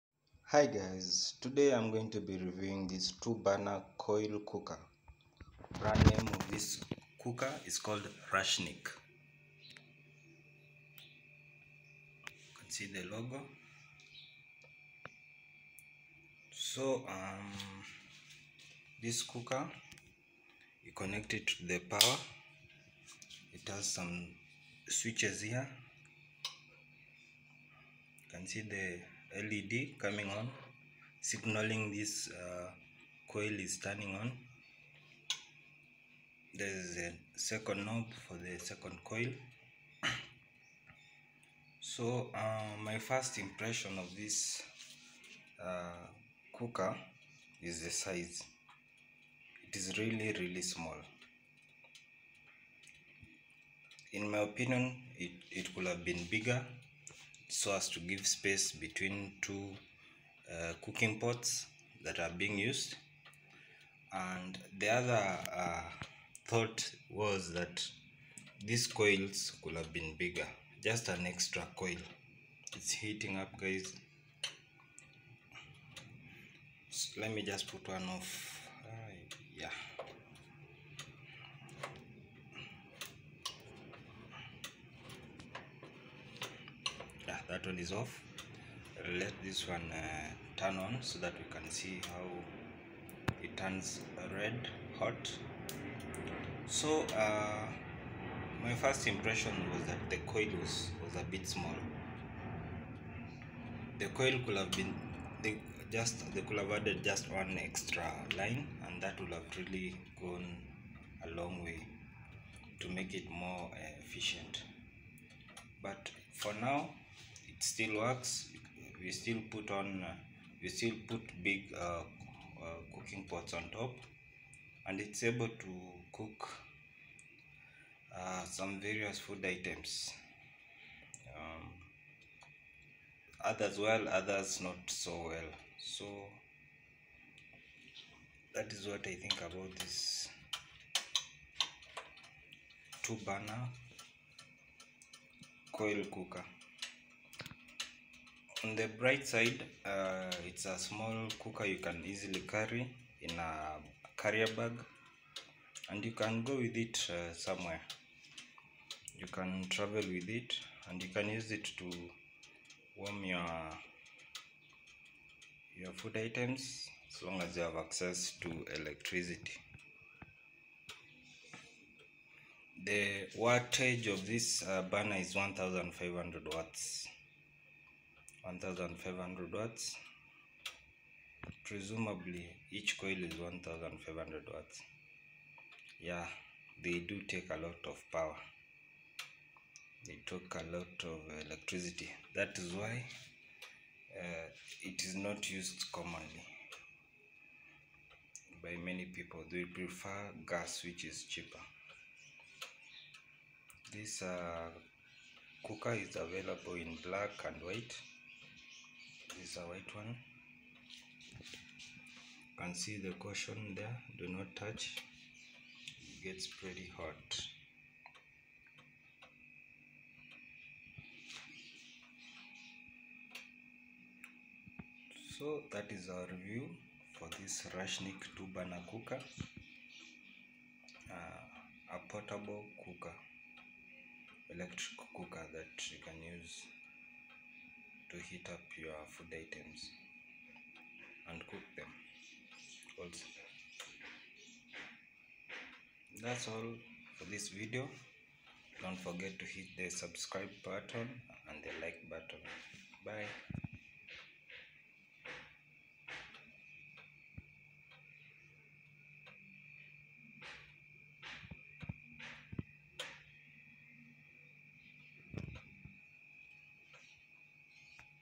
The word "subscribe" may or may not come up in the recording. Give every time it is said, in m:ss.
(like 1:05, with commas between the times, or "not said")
4:09.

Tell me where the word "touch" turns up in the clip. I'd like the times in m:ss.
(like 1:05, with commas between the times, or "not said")
3:34.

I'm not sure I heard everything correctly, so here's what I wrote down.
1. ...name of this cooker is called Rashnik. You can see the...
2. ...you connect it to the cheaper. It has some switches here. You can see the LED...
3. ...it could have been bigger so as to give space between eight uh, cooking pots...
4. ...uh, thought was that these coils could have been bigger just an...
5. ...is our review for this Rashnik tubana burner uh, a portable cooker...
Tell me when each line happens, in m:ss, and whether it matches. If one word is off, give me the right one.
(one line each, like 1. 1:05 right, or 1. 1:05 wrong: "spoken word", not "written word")
1. 0:06 right
2. 0:20 wrong: "power", not "cheaper"
3. 0:55 wrong: "two", not "eight"
4. 1:05 right
5. 3:45 wrong: "cooker", not "burner".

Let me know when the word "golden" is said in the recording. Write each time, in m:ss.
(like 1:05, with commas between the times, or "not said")
not said.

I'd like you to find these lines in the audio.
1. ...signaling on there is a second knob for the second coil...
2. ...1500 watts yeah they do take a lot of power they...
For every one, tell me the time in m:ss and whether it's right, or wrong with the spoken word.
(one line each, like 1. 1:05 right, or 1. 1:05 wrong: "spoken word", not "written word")
1. 0:33 wrong: "turning", not "signaling"
2. 3:03 right.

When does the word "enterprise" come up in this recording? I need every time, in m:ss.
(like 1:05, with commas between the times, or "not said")
not said.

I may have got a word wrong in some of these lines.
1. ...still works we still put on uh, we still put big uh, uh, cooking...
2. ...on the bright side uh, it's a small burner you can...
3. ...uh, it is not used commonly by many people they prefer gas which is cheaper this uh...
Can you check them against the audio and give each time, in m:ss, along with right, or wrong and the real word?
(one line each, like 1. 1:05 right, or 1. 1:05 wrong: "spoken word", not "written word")
1. 1:57 right
2. 2:28 wrong: "cooker", not "burner"
3. 3:14 right.